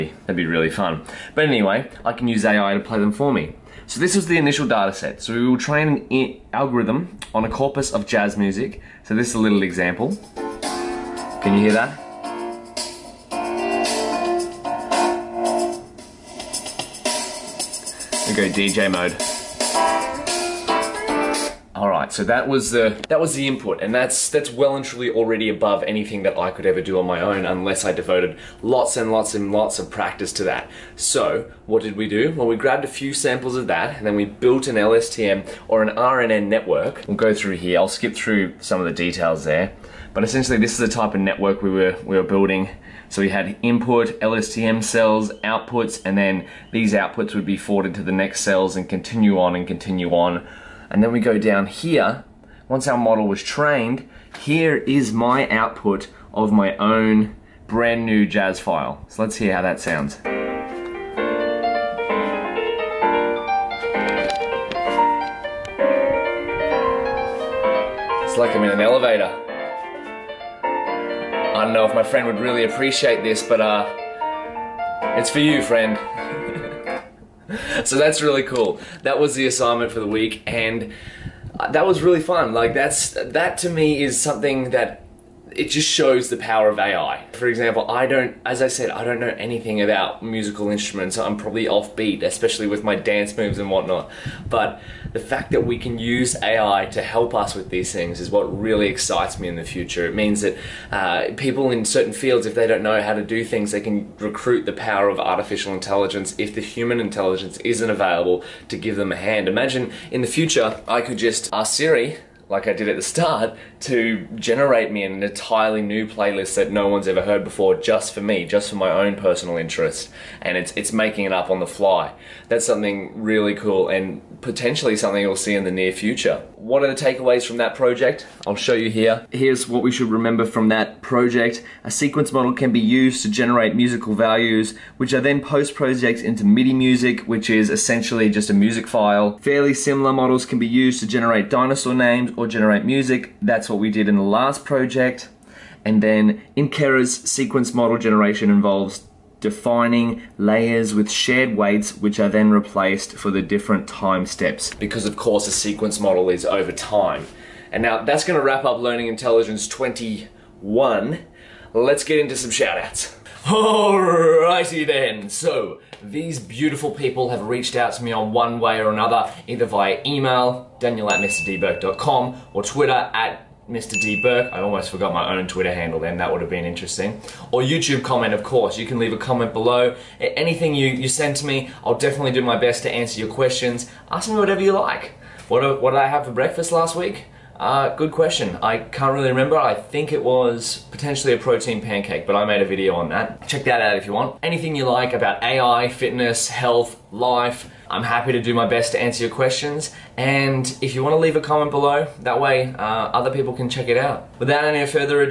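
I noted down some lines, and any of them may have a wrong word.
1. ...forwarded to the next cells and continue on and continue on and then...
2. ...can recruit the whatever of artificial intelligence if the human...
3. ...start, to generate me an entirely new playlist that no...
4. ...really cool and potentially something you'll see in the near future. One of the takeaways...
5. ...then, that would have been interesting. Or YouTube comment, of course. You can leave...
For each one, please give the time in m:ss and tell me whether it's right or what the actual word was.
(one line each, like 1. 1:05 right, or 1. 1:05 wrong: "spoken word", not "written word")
1. 0:47 right
2. 1:43 wrong: "power", not "whatever"
3. 1:53 right
4. 2:03 right
5. 2:55 right.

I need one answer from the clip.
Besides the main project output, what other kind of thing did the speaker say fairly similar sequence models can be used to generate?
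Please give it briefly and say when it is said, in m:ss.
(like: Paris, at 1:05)
Dinosaur names, at 2:21.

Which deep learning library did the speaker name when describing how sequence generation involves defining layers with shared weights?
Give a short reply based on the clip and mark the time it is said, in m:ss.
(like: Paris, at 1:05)
Keras, at 2:26.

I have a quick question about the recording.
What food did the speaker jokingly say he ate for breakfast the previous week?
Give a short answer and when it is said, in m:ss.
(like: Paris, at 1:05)
Protein pancake, at 3:11.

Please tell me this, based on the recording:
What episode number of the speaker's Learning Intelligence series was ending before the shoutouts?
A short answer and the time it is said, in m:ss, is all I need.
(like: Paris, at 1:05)
21, at 2:39.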